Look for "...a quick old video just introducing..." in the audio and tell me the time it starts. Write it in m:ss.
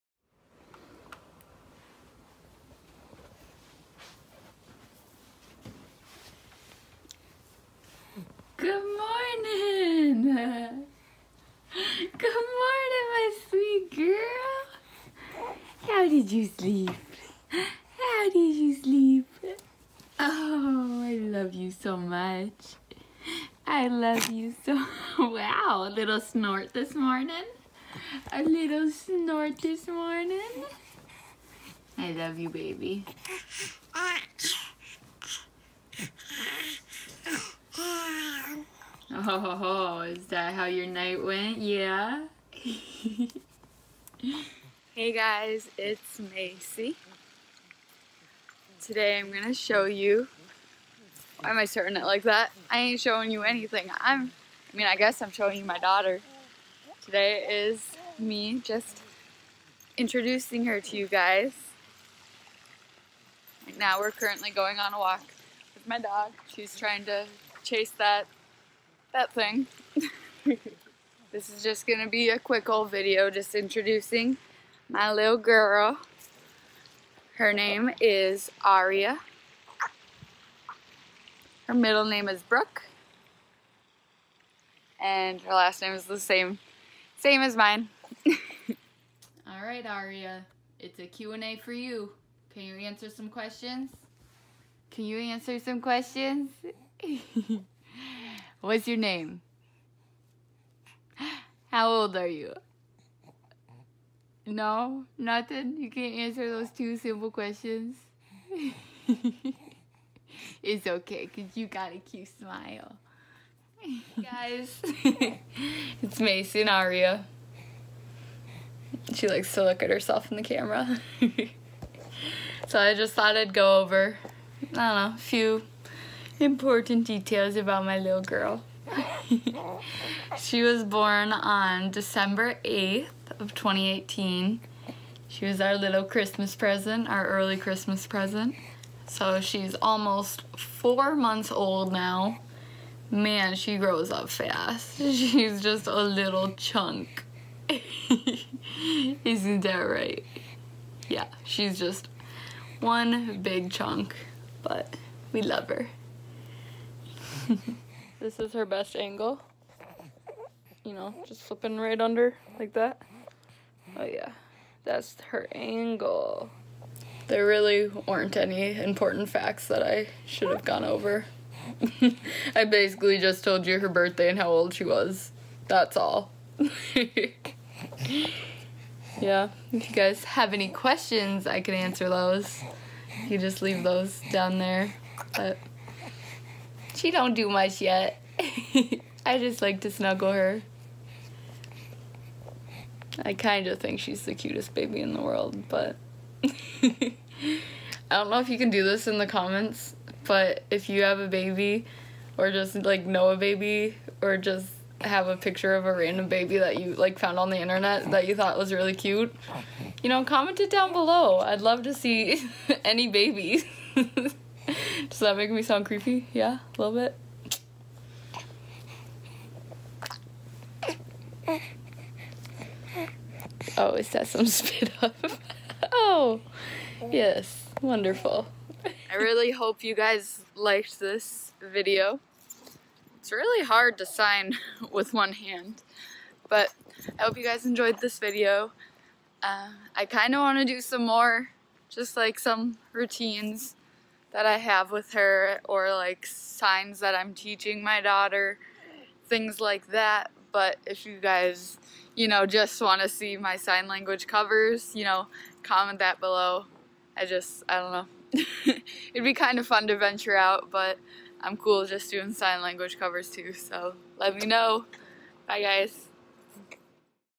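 1:12.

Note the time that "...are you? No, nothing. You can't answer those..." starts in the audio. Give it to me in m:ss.
1:42.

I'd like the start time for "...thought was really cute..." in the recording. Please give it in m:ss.
3:28.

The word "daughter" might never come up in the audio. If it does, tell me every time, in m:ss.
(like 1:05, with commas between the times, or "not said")
0:55, 4:08.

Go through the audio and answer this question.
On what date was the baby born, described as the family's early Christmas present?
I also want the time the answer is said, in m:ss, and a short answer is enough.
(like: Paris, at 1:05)
December 8, 2018, at 2:11.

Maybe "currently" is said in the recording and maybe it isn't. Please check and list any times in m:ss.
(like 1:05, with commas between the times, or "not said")
1:04.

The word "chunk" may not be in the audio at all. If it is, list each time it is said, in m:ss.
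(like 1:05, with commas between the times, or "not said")
2:26, 2:33.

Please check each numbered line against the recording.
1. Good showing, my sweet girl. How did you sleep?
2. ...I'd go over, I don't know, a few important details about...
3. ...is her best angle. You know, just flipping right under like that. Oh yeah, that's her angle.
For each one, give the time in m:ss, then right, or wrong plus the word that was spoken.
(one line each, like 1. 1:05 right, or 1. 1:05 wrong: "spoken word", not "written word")
1. 0:10 wrong: "morning", not "showing"
2. 2:03 right
3. 2:38 right.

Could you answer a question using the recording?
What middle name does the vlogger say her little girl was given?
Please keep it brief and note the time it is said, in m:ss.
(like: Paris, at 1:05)
Brooke, at 1:21.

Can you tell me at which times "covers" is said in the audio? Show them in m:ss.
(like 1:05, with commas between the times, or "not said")
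4:14, 4:22.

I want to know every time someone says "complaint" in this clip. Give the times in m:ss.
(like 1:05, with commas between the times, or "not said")
not said.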